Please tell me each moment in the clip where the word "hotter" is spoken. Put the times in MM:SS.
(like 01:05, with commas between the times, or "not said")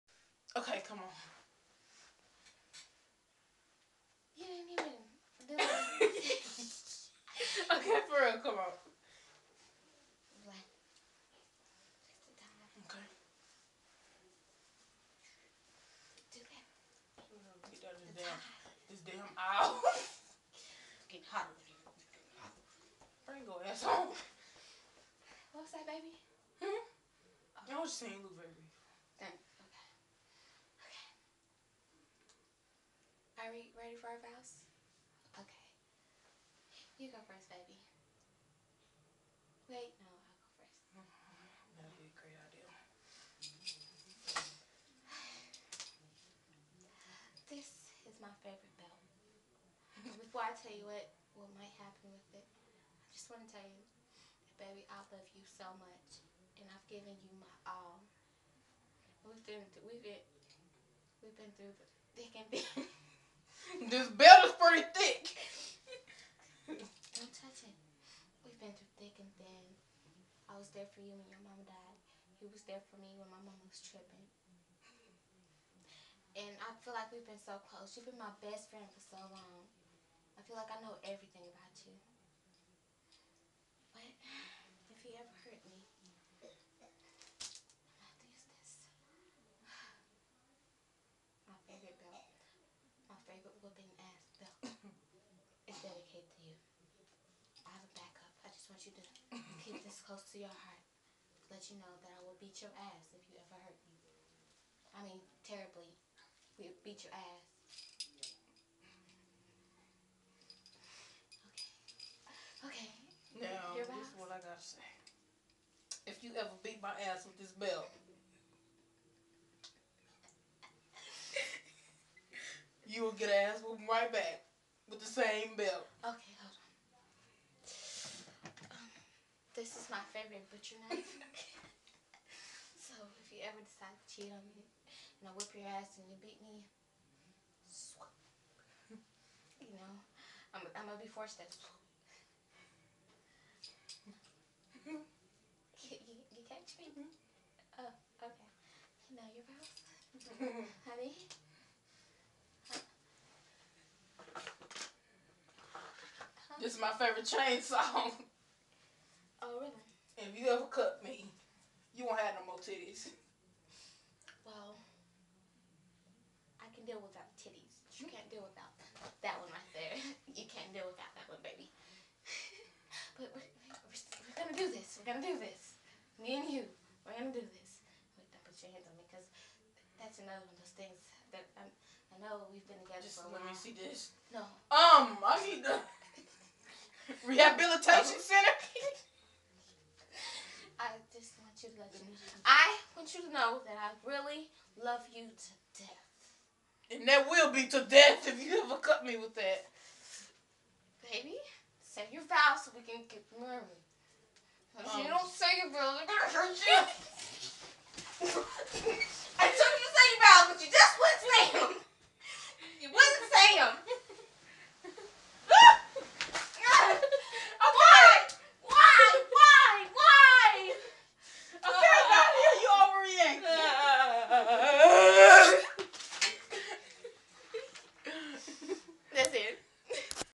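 00:21.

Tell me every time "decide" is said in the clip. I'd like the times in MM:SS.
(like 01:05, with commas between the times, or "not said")
02:13.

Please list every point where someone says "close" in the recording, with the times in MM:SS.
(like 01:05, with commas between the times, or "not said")
01:17, 01:40.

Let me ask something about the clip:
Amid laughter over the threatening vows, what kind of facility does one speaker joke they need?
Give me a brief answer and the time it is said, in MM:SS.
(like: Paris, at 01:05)
rehabilitation center, at 03:07.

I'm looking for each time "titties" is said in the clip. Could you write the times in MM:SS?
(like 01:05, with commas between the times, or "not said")
02:42, 02:47.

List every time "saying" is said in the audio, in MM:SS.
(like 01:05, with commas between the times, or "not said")
00:28.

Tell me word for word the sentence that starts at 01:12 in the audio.
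He was there for me when my mom was tripping.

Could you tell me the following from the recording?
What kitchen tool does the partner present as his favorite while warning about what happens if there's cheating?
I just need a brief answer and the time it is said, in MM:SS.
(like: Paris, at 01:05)
butcher knife, at 02:10.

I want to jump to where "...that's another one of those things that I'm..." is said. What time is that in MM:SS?
02:59.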